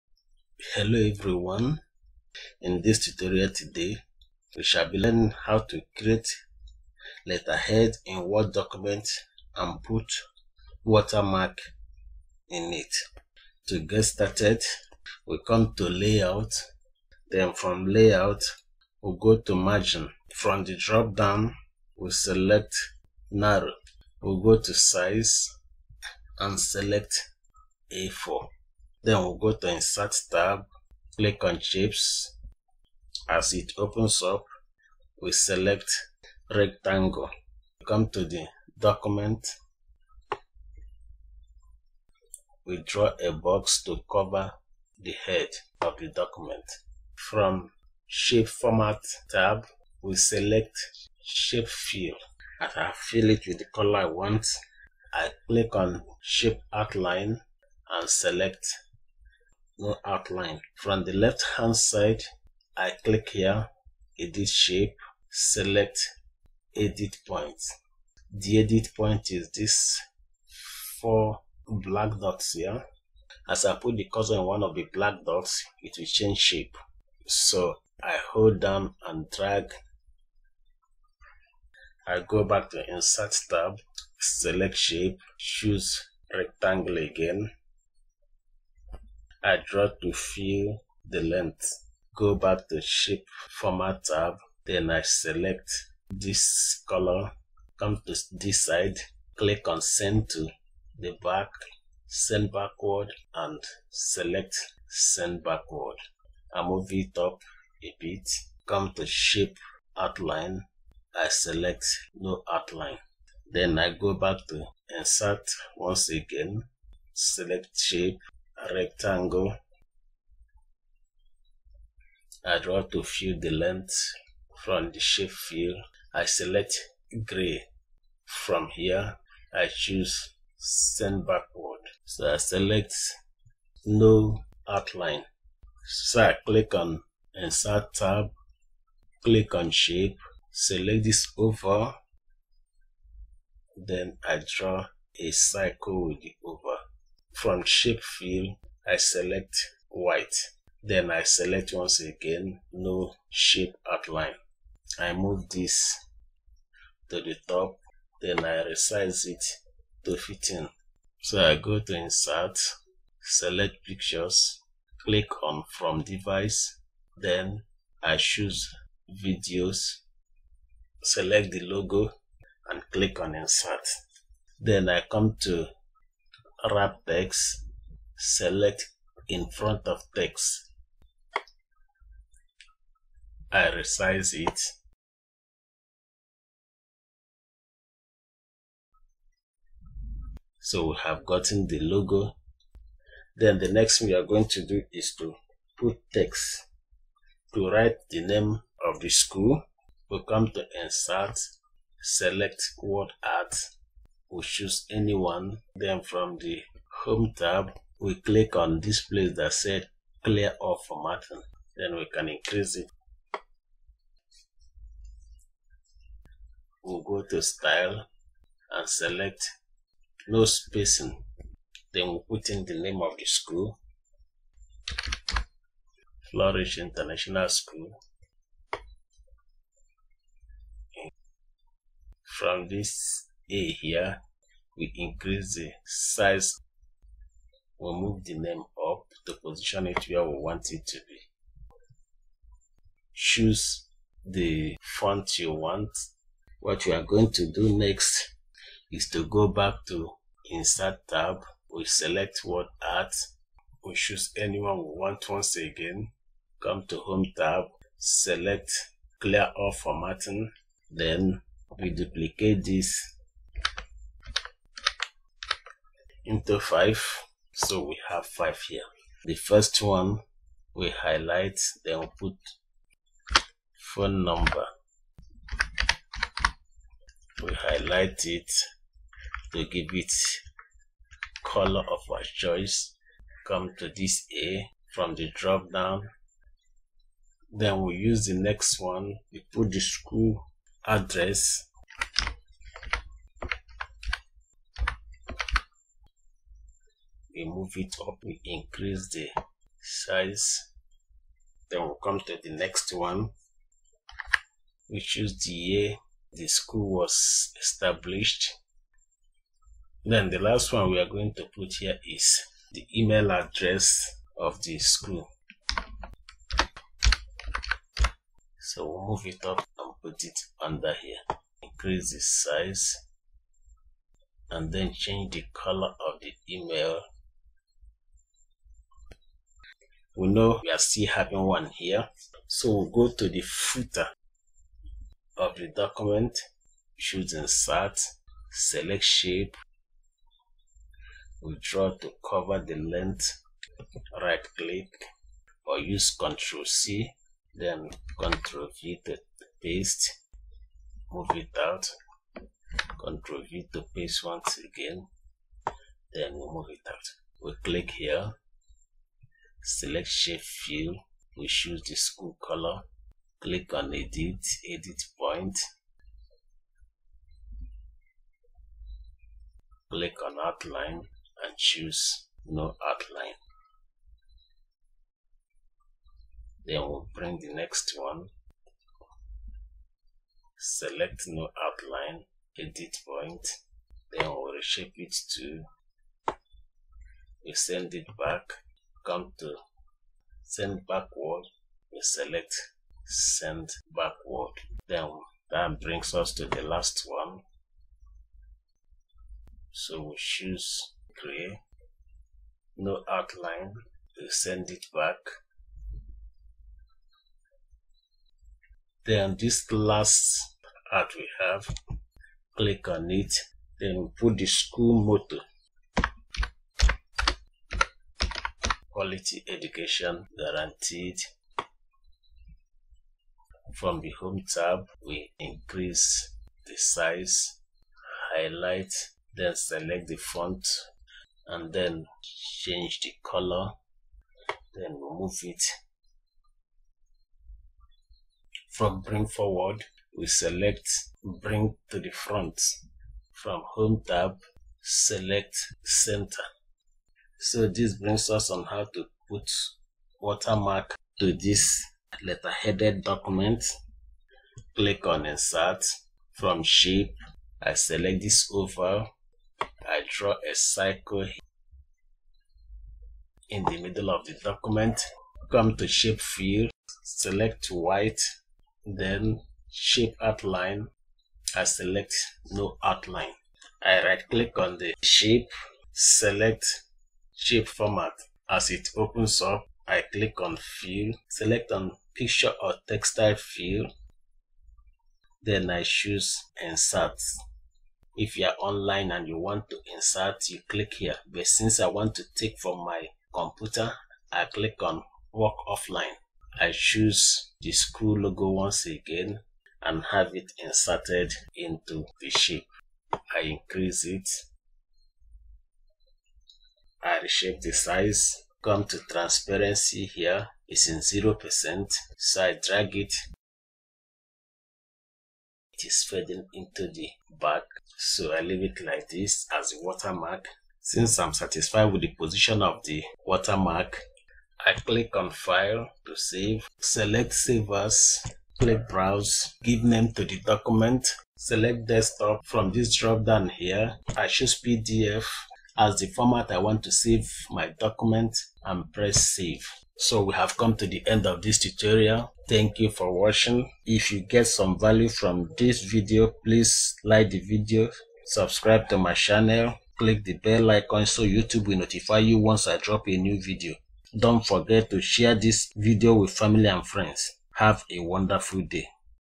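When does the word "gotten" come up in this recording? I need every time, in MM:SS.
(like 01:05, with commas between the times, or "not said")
03:11.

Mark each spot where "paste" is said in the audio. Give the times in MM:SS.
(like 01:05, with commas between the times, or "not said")
05:49, 05:53.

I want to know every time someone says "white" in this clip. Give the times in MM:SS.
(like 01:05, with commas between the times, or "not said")
02:29, 07:47.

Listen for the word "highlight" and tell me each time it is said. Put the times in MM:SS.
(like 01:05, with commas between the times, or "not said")
04:30, 04:37, 07:08.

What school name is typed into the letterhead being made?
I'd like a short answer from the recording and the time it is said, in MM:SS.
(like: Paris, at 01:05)
Flourish International School, at 03:46.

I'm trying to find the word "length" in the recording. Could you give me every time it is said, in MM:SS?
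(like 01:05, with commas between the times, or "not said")
01:31, 02:03, 05:42.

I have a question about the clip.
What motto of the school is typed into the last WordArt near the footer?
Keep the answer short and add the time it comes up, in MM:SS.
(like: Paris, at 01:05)
Quality education guaranteed, at 06:58.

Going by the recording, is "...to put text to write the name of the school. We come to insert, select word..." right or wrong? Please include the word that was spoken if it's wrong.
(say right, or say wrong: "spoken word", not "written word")
right.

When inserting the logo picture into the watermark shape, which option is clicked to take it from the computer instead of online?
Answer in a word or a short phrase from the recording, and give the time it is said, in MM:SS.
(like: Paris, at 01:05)
Work offline, at 08:15.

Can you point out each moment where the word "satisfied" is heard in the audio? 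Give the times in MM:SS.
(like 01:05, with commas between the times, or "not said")
08:41.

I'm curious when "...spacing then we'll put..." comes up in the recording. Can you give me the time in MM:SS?
03:40.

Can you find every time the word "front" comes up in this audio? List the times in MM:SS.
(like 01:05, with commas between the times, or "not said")
02:59, 07:22.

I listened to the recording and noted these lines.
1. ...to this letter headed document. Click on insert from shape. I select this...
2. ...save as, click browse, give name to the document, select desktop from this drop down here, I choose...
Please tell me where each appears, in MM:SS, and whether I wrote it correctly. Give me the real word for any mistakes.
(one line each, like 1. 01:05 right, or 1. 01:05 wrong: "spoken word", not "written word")
1. 07:31 right
2. 08:47 right.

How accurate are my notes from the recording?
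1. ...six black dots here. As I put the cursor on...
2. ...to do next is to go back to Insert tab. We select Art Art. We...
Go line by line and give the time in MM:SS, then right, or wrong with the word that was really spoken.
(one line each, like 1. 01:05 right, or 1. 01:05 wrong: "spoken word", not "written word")
1. 01:11 wrong: "four", not "six"
2. 04:07 wrong: "Word", not "Art".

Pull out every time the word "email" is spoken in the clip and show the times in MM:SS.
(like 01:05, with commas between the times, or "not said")
05:12, 05:26.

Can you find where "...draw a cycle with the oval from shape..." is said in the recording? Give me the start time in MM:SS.
02:24.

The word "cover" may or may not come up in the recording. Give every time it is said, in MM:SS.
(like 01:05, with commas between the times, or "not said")
00:44, 05:42.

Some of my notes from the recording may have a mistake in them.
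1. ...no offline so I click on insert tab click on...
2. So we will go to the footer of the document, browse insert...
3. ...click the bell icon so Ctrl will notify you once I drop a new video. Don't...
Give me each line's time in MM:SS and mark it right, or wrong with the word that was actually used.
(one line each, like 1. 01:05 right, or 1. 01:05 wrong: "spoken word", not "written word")
1. 02:13 wrong: "outline", not "offline"
2. 05:32 wrong: "choose", not "browse"
3. 09:09 wrong: "YouTube", not "Ctrl".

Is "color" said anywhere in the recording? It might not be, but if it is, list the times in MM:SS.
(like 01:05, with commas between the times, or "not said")
00:53, 01:36, 04:41, 05:25, 06:02, 07:13.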